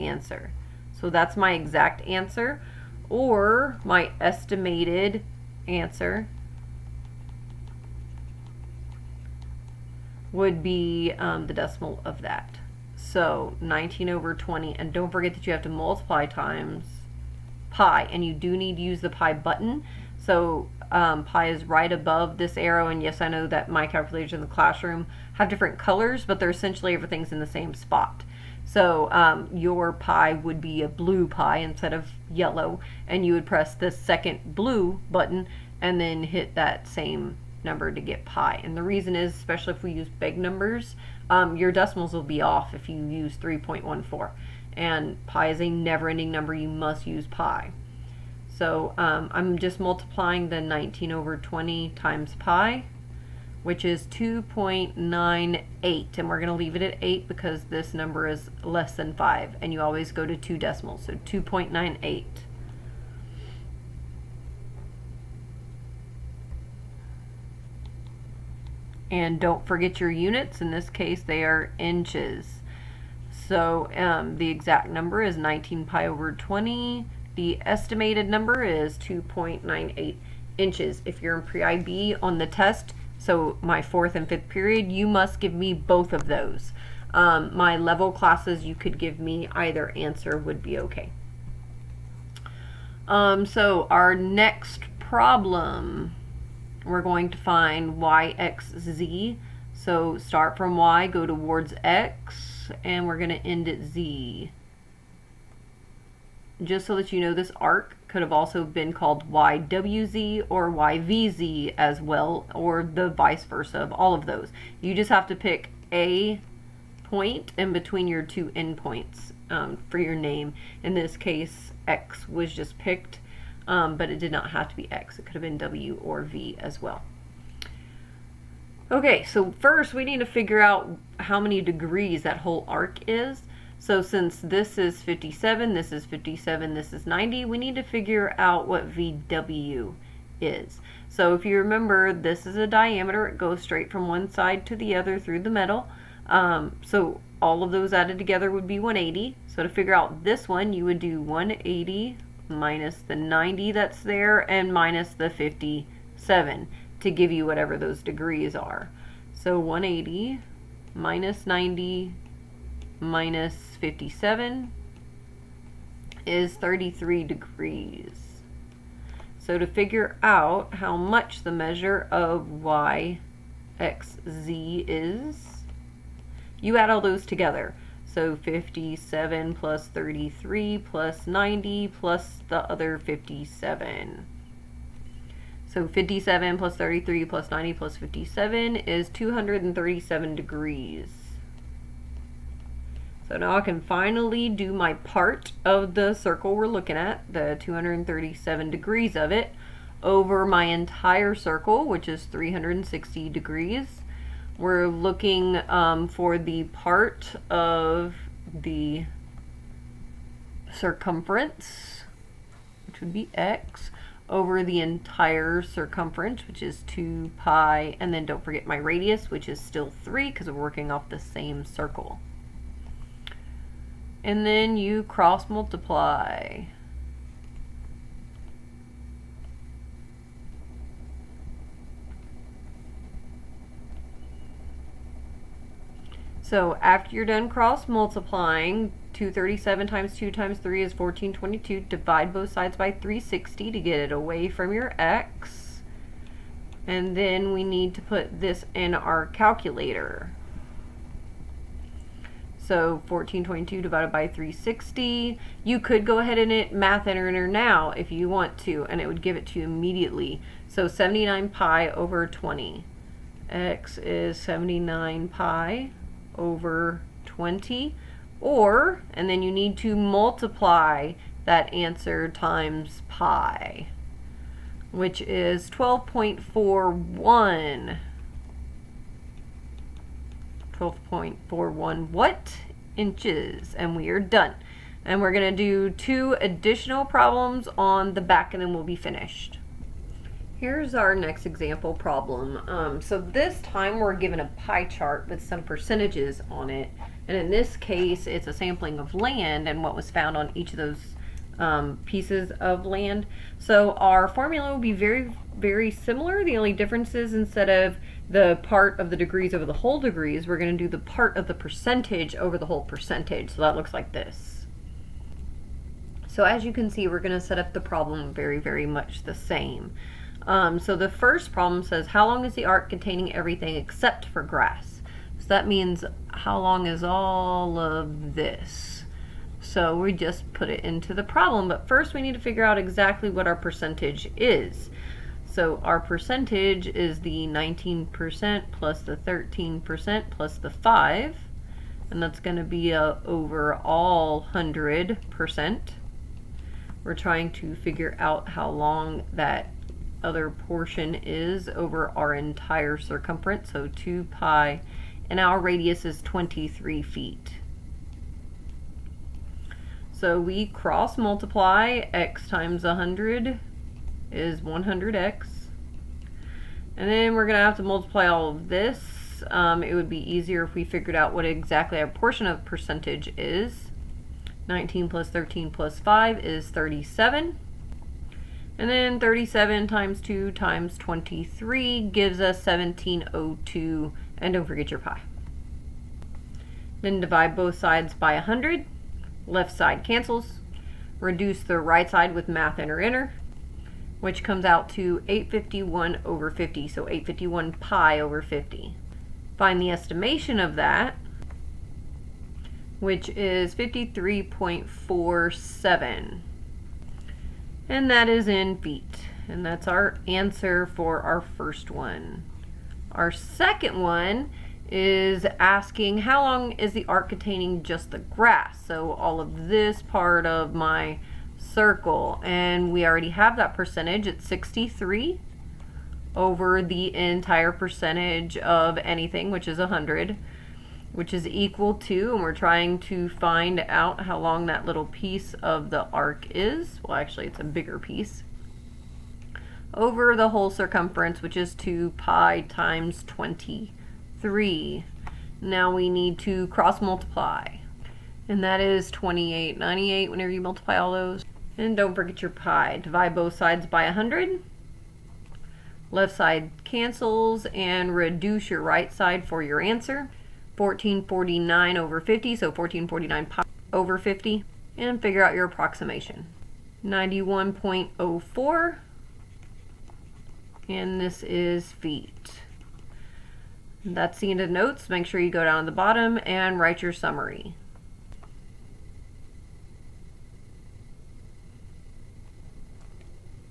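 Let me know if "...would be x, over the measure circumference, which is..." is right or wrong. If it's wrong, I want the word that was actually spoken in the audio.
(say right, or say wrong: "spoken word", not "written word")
wrong: "entire", not "measure".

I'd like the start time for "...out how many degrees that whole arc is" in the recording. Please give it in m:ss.
2:10.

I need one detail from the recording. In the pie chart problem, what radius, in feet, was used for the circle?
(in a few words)
23 feet.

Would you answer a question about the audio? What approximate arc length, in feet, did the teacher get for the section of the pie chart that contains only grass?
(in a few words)
91.04.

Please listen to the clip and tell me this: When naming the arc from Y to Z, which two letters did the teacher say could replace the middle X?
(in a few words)
W or V.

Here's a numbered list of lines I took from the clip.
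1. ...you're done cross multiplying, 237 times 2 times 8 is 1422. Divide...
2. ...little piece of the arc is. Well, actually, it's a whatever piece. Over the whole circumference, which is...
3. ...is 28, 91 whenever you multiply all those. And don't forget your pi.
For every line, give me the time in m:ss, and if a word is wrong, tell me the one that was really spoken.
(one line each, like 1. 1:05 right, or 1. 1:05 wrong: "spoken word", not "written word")
1. 3:57 wrong: "3", not "8"
2. 7:14 wrong: "bigger", not "whatever"
3. 7:28 wrong: "98", not "91".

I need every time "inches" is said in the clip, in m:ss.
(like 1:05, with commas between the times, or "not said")
1:11, 1:20, 4:42.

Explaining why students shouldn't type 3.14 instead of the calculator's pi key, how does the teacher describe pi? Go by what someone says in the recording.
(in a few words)
never-ending number.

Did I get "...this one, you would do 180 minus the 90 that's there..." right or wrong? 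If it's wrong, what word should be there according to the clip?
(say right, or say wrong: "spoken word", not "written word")
right.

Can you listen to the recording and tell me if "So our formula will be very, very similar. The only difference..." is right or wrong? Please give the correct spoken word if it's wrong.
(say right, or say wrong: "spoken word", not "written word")
right.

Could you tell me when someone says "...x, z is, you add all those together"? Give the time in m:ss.
2:53.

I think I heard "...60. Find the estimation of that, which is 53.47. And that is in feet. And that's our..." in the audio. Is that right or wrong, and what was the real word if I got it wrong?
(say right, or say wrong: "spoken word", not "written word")
wrong: "50", not "60".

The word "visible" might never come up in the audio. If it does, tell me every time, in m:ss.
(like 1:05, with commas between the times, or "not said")
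not said.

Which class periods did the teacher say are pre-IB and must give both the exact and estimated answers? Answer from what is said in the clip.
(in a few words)
fourth and fifth.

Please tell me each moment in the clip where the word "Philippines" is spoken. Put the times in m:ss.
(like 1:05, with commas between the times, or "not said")
not said.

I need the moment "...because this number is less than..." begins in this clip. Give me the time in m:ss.
0:57.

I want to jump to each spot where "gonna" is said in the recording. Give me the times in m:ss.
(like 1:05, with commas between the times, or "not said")
4:45.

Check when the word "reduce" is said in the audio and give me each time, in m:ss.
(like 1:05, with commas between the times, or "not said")
6:31, 7:38.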